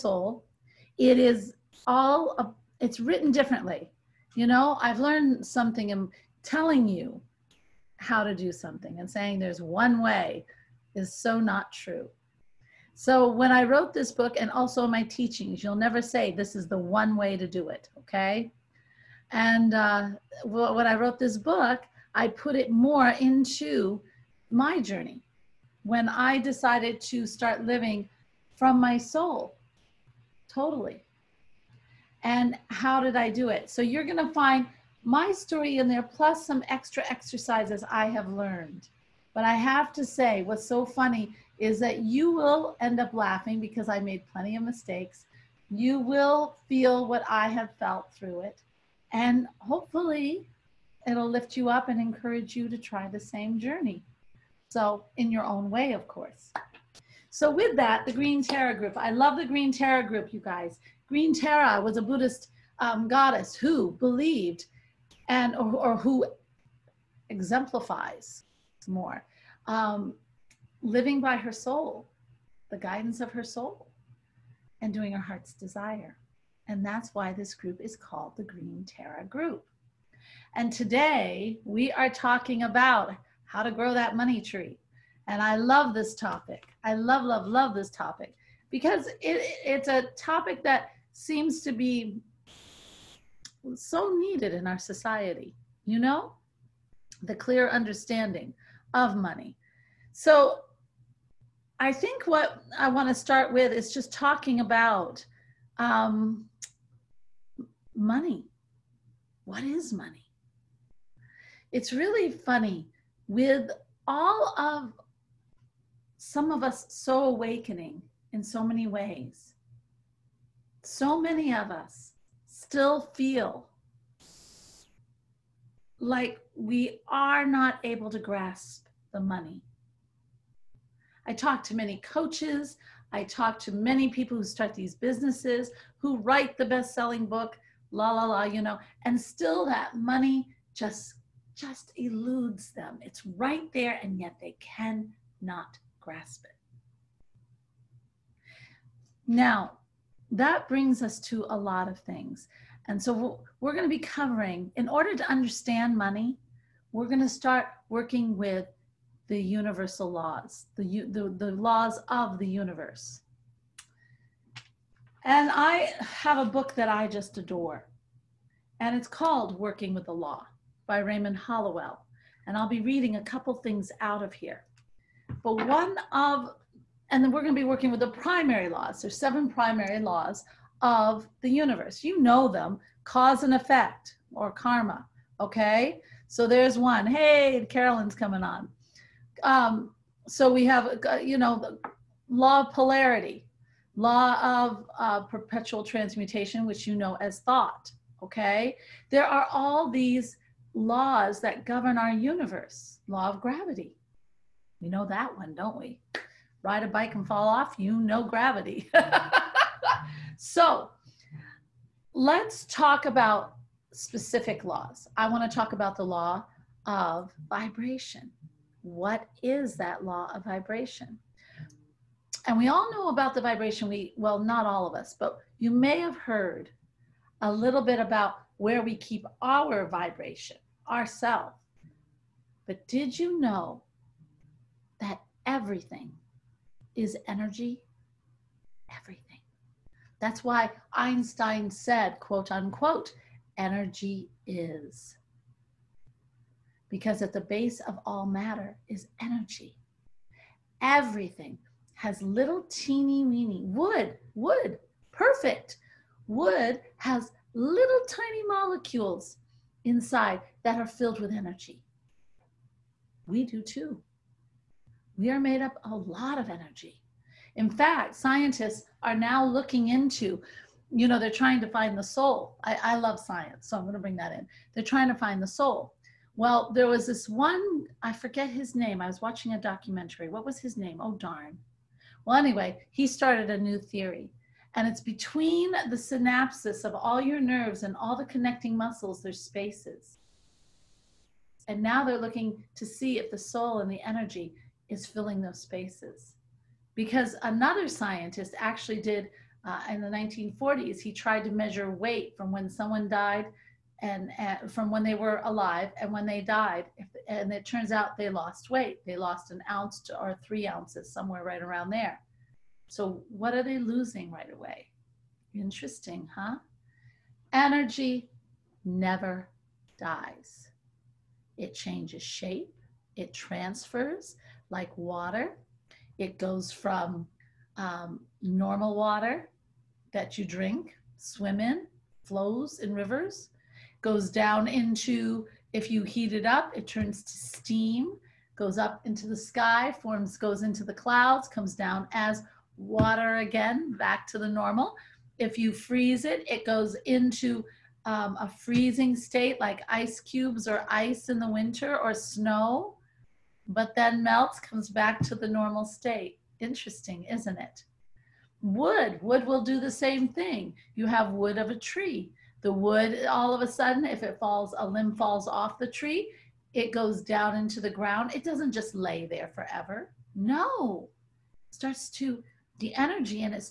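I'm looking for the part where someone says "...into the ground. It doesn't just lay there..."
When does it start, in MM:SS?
06:07.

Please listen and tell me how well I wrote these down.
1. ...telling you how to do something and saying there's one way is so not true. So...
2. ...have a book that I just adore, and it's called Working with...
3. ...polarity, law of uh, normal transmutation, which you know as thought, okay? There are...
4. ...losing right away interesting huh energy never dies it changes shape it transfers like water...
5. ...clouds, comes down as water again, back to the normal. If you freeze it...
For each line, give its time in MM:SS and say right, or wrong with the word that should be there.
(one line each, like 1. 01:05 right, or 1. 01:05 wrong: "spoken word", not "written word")
1. 00:06 right
2. 02:46 right
3. 03:12 wrong: "perpetual", not "normal"
4. 05:13 right
5. 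05:40 right.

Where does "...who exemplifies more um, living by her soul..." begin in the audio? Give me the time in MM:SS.
01:05.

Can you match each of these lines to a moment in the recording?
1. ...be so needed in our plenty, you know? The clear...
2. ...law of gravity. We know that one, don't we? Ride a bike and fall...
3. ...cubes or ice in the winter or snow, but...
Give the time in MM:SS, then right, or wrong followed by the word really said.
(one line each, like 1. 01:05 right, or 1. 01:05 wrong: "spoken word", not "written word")
1. 01:31 wrong: "society", not "plenty"
2. 03:23 right
3. 05:50 right.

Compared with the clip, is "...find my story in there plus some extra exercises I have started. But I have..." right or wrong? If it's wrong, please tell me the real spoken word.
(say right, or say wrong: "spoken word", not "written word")
wrong: "learned", not "started".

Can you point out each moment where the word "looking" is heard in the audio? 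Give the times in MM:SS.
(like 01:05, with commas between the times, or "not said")
04:29, 04:52.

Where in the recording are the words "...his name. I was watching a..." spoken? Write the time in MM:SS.
04:38.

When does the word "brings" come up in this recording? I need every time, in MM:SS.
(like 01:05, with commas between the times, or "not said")
02:30, 04:33.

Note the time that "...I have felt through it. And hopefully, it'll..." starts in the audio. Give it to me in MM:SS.
00:47.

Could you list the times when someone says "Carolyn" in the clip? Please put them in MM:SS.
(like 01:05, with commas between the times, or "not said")
03:07.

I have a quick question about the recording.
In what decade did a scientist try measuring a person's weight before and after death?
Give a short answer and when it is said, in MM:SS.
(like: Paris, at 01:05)
1940s, at 05:00.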